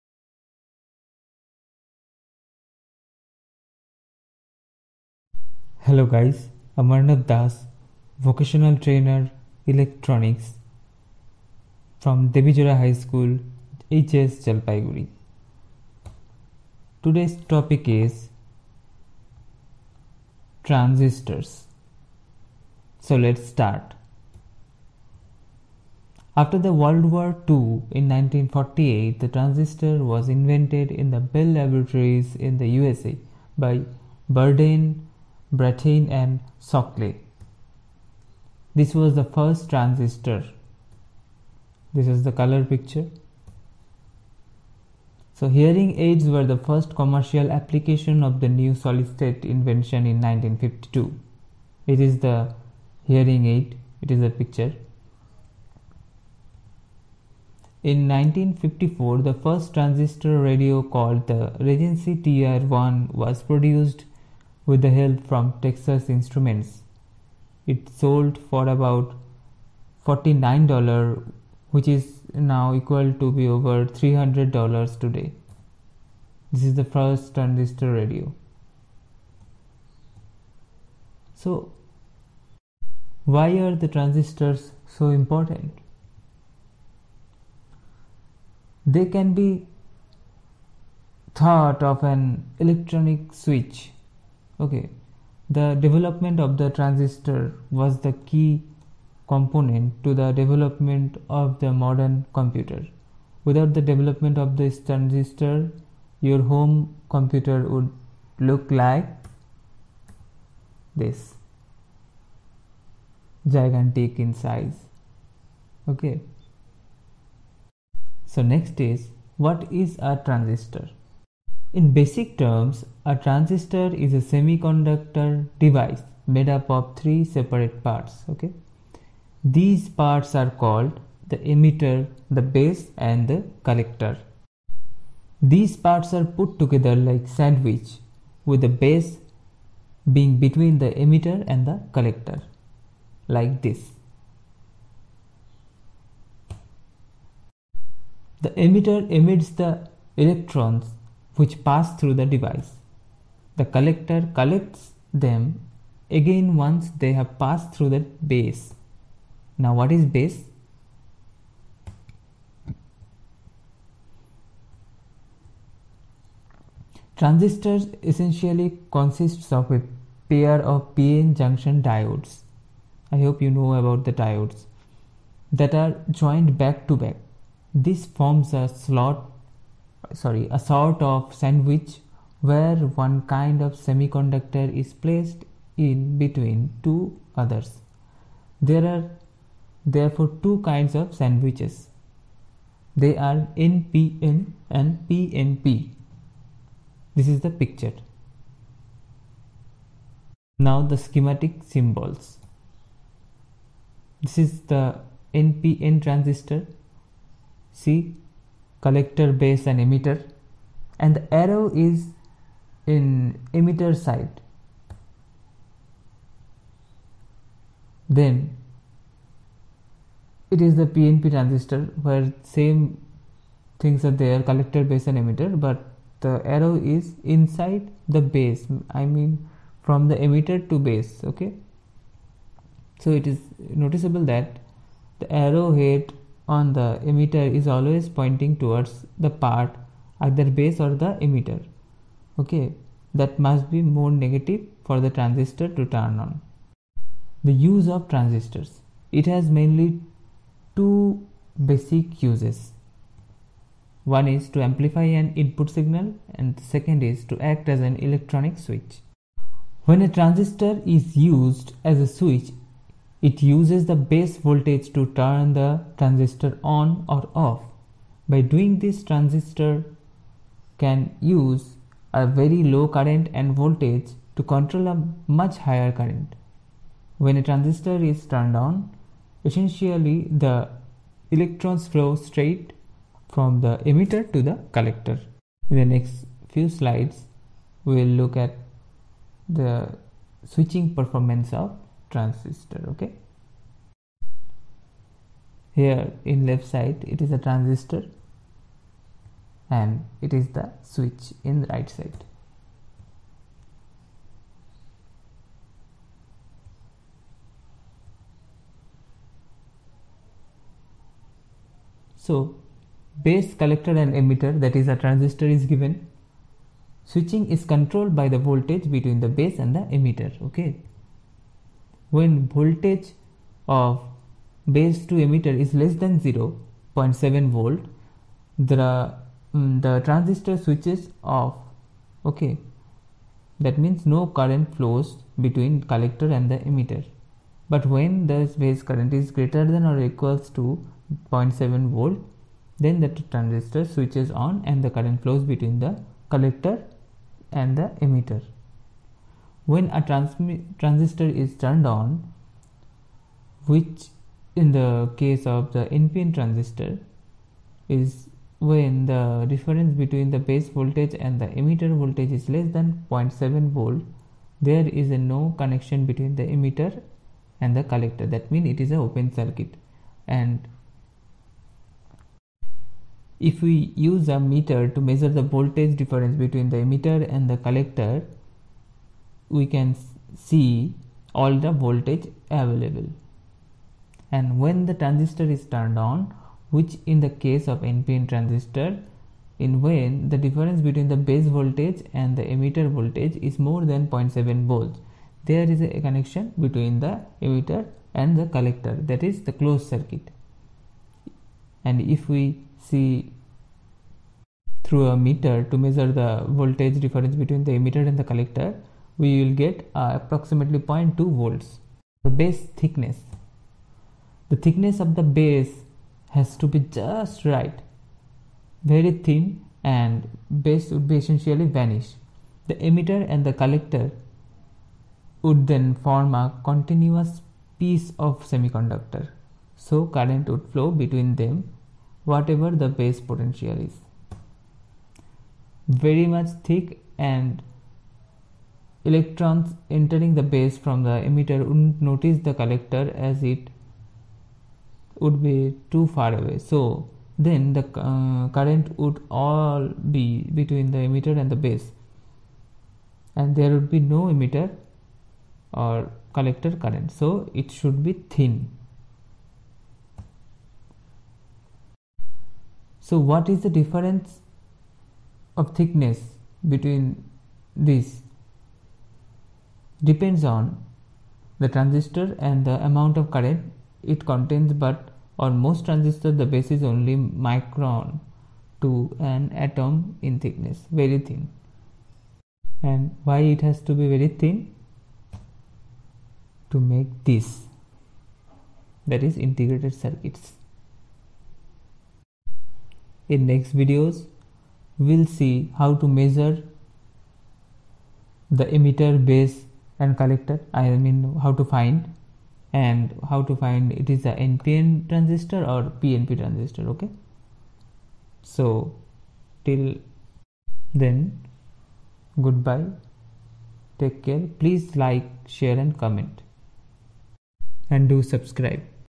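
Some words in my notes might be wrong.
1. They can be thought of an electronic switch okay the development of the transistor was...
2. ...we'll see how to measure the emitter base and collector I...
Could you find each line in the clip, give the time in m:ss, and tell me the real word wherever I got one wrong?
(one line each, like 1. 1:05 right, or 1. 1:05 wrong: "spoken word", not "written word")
1. 1:28 right
2. 8:14 right.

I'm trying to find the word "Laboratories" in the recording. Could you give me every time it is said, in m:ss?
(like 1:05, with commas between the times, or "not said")
0:31.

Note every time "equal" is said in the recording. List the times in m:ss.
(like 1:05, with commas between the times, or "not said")
1:12, 5:40.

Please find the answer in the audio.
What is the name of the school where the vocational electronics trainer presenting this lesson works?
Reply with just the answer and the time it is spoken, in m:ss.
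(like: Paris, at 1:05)
Devijora High School, at 0:12.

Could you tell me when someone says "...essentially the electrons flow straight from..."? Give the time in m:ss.
4:39.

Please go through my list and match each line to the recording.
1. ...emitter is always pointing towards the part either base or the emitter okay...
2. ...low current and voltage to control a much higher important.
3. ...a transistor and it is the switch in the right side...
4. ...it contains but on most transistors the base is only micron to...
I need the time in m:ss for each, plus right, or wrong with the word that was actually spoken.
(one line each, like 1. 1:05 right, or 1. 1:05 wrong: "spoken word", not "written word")
1. 3:57 right
2. 4:32 wrong: "current", not "important"
3. 4:57 right
4. 7:54 right.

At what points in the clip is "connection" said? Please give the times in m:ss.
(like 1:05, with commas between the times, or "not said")
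6:05, 6:36.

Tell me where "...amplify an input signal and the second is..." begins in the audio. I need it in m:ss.
4:14.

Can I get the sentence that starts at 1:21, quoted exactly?
So, why are the transistors so important?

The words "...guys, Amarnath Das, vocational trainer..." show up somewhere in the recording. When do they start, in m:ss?
0:06.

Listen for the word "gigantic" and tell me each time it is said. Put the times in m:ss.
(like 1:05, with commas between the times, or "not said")
1:53.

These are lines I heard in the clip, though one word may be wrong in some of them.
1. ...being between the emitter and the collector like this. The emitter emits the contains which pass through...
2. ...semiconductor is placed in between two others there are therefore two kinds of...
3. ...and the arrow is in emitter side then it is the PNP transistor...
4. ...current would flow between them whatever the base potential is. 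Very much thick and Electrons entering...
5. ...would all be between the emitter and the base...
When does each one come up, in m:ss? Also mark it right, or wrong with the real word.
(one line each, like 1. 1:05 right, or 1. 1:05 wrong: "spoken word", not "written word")
1. 2:20 wrong: "electrons", not "contains"
2. 3:03 right
3. 3:30 right
4. 7:10 right
5. 7:28 right.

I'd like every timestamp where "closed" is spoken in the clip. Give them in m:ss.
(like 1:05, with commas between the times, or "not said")
6:39.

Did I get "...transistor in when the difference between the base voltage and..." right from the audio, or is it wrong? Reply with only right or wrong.
right.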